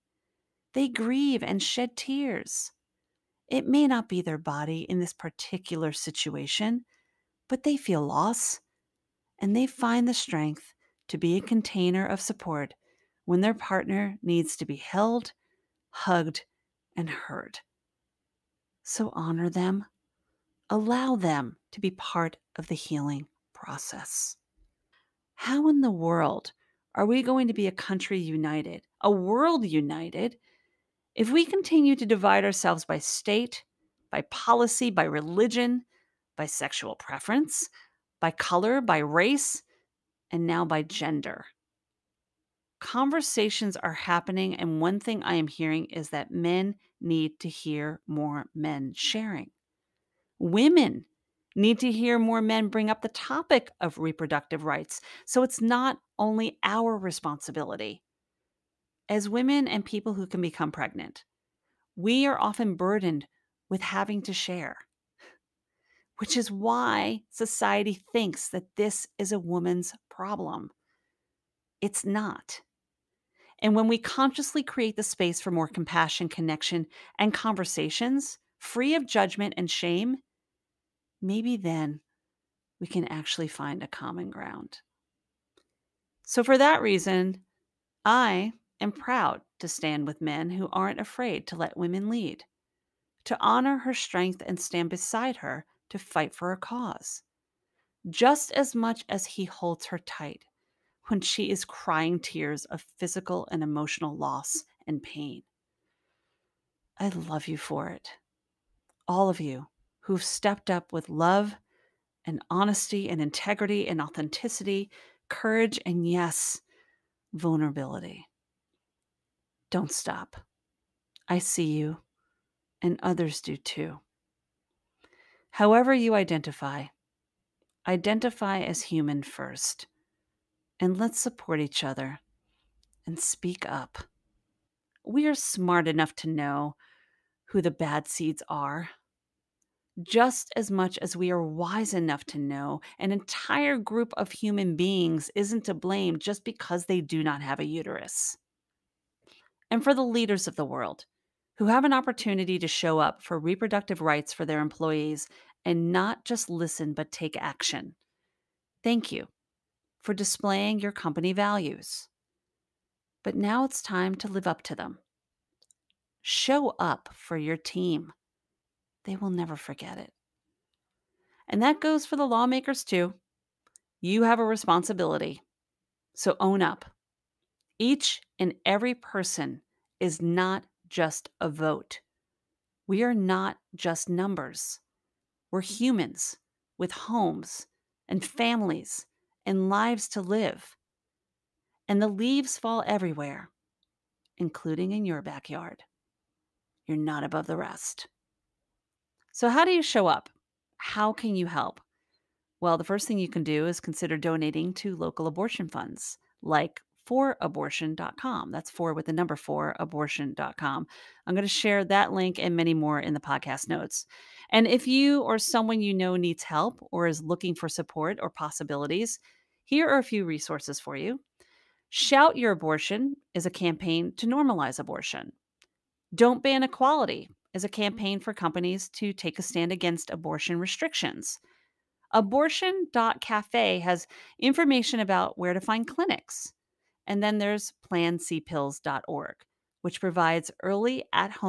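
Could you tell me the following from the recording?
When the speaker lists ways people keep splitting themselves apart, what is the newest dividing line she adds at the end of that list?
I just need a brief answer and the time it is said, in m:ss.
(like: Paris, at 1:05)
gender, at 0:40.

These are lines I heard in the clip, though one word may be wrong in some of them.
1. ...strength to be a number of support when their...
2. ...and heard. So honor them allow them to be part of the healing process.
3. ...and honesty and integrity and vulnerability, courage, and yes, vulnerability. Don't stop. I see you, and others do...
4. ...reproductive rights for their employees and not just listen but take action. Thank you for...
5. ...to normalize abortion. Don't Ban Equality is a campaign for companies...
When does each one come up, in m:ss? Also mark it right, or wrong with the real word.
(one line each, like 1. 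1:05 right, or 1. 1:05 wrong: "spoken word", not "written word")
1. 0:10 wrong: "container", not "number"
2. 0:16 right
3. 1:52 wrong: "authenticity", not "vulnerability"
4. 2:33 right
5. 3:44 right.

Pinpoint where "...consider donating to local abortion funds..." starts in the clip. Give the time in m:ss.
3:23.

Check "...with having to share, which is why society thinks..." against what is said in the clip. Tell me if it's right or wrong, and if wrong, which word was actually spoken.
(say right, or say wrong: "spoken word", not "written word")
right.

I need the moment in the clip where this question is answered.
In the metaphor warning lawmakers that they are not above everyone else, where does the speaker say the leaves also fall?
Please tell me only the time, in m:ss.
3:15.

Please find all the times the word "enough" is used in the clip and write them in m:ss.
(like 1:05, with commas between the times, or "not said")
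2:15, 2:21.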